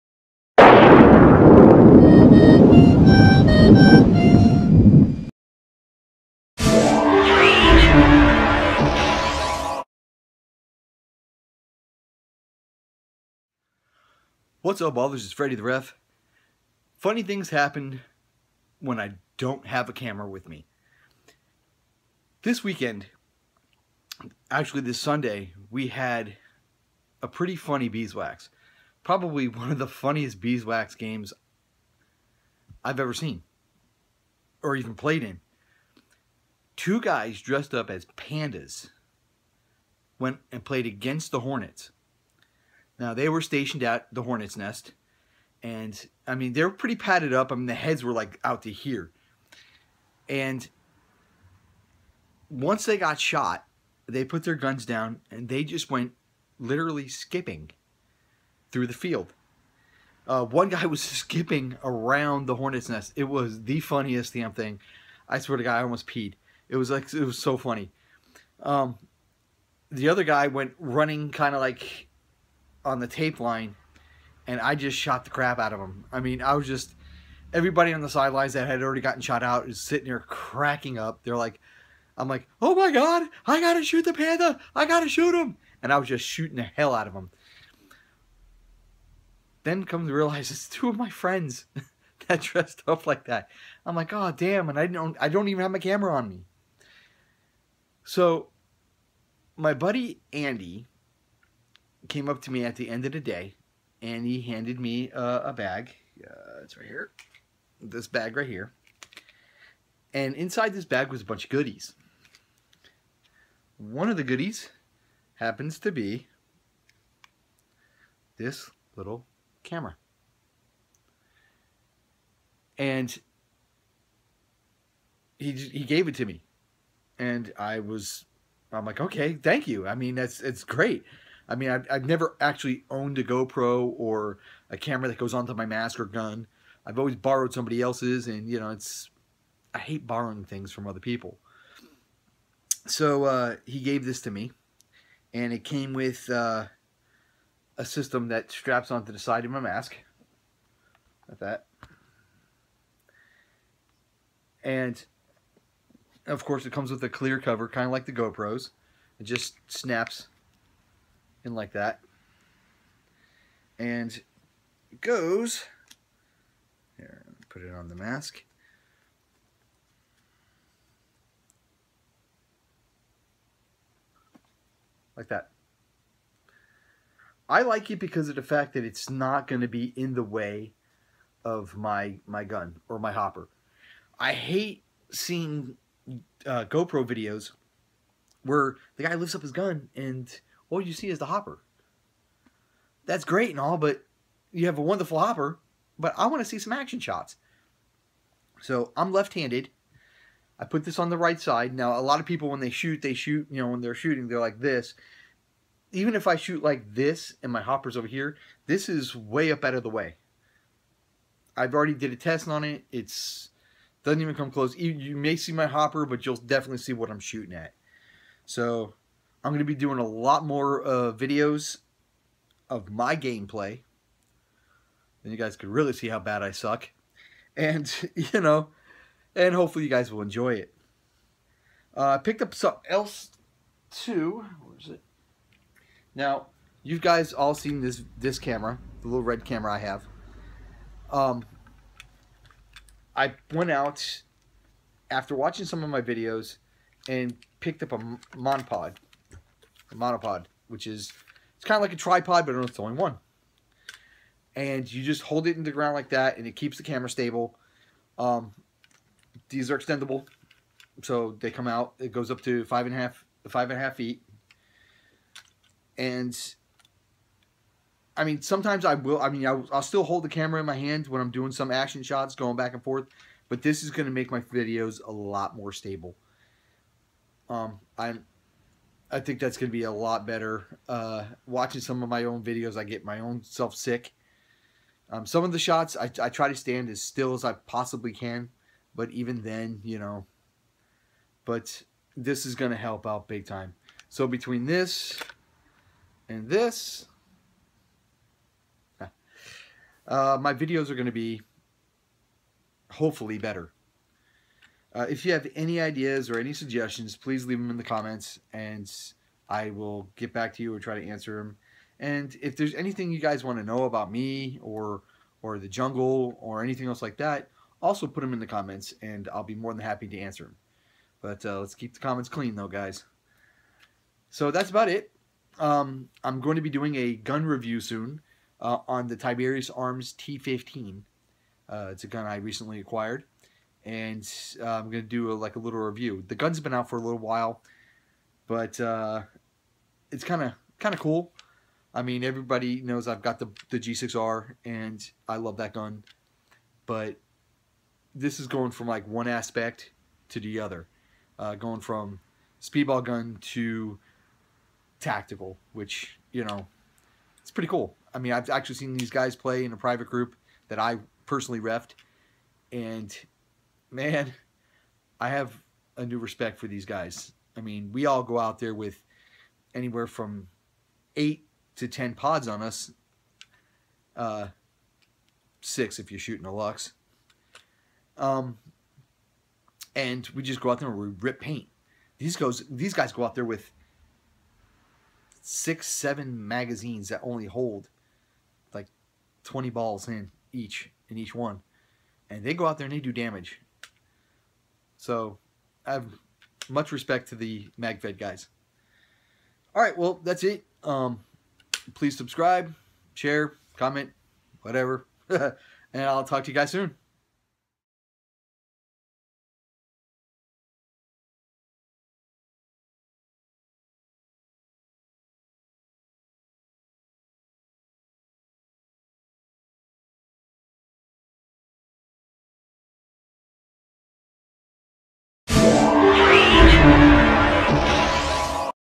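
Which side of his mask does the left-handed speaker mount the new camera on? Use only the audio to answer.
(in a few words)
Right side.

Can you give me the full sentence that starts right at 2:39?
It just snaps in like that.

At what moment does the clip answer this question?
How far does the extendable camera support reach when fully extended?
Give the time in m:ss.
4:23.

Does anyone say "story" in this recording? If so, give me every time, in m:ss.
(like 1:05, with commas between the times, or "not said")
not said.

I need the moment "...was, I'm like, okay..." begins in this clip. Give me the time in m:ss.
2:07.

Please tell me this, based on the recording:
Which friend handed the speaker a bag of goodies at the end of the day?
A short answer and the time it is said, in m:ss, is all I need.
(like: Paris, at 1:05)
Andy, at 1:40.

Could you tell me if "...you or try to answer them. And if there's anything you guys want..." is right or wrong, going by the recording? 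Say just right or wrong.
right.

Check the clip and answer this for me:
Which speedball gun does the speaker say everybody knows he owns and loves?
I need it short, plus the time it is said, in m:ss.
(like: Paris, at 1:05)
G6R, at 5:43.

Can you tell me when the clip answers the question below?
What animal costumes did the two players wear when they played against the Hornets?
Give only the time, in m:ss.
0:38.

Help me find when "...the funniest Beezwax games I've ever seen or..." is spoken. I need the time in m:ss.
0:29.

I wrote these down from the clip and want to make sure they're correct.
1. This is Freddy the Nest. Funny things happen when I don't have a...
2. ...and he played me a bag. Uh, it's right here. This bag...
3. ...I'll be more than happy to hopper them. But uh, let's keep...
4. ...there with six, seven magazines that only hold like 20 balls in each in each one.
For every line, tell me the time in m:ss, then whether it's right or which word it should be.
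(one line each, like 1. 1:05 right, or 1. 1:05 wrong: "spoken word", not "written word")
1. 0:15 wrong: "Ref", not "Nest"
2. 1:44 wrong: "handed", not "played"
3. 5:19 wrong: "answer", not "hopper"
4. 6:23 right.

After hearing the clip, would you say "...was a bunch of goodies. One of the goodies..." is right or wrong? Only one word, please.
right.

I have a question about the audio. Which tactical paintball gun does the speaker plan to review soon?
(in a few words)
Tiberius Arms T15.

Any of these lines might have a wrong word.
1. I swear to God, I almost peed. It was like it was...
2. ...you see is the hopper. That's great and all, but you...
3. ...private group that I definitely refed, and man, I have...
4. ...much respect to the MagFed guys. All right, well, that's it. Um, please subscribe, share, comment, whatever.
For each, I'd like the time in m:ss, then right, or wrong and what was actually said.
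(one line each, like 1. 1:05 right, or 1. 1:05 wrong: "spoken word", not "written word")
1. 1:05 right
2. 3:10 right
3. 5:59 wrong: "personally", not "definitely"
4. 6:36 right.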